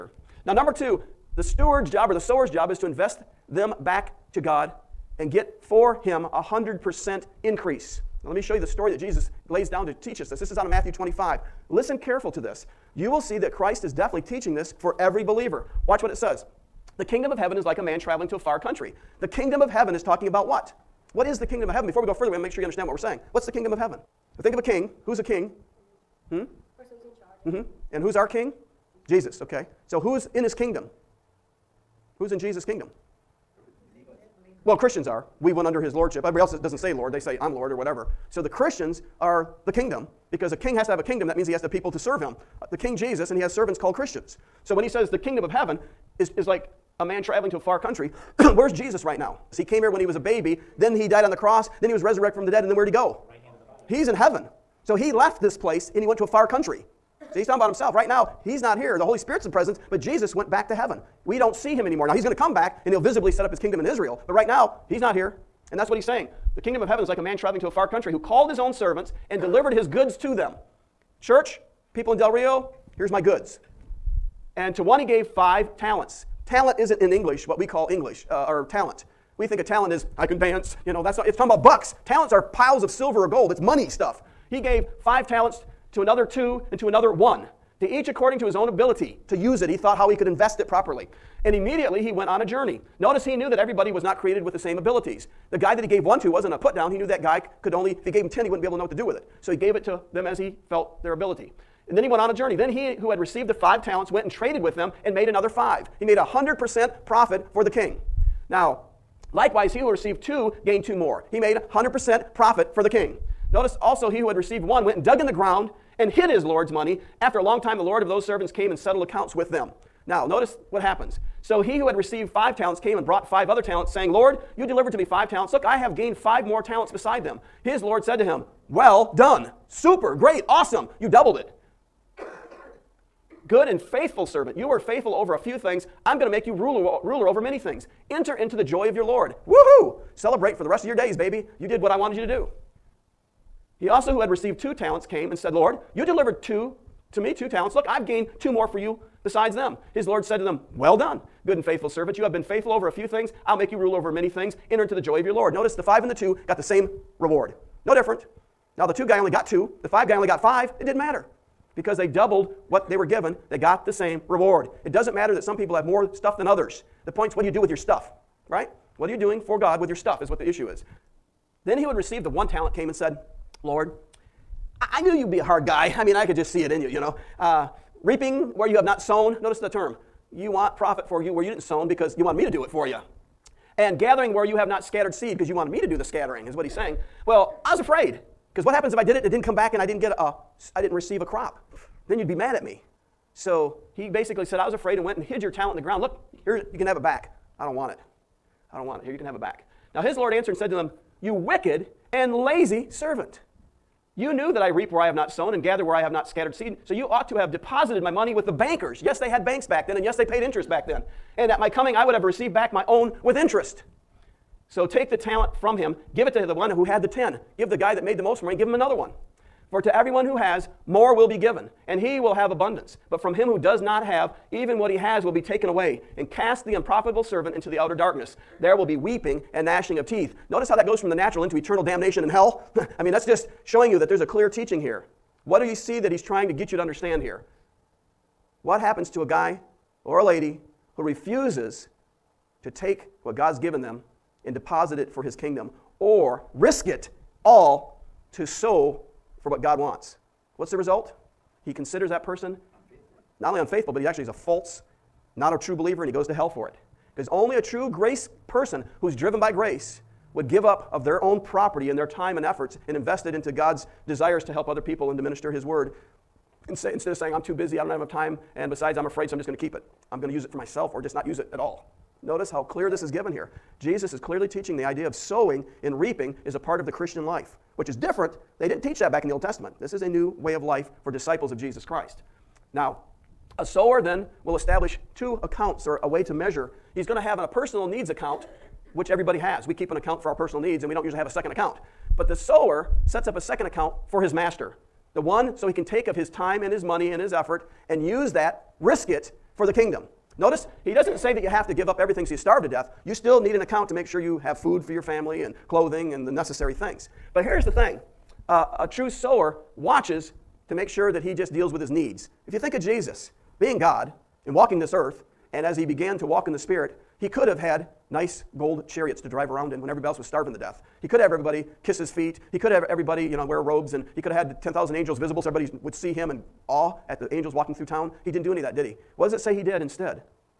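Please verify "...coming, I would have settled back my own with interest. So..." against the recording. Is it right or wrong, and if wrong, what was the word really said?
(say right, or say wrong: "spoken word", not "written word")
wrong: "received", not "settled".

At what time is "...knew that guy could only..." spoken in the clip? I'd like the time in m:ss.
1:36.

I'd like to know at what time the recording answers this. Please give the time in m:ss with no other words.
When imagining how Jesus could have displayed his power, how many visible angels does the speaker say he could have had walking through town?
5:24.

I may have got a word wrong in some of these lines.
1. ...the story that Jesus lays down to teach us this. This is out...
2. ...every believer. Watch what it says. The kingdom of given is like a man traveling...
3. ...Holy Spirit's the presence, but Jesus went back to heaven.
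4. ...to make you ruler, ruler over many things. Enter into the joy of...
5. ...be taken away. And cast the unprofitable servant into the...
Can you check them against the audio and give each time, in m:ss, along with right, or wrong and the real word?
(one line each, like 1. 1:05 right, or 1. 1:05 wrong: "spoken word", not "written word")
1. 0:08 right
2. 0:14 wrong: "heaven", not "given"
3. 0:59 right
4. 2:16 right
5. 3:45 right.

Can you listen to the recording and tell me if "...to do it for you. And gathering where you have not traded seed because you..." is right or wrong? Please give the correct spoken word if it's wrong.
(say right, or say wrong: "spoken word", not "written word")
wrong: "scattered", not "traded".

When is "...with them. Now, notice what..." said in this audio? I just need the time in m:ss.
1:59.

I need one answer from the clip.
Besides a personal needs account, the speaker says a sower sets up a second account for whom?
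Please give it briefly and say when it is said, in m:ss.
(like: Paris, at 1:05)
his master, at 4:54.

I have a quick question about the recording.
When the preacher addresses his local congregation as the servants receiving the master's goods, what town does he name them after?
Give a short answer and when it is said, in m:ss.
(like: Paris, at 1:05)
Del Rio, at 1:12.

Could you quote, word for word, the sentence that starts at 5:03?
You still need an account to make sure you have food for your family and clothing and the necessary things.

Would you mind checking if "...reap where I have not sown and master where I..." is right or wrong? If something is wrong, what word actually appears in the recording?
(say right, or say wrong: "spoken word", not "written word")
wrong: "gather", not "master".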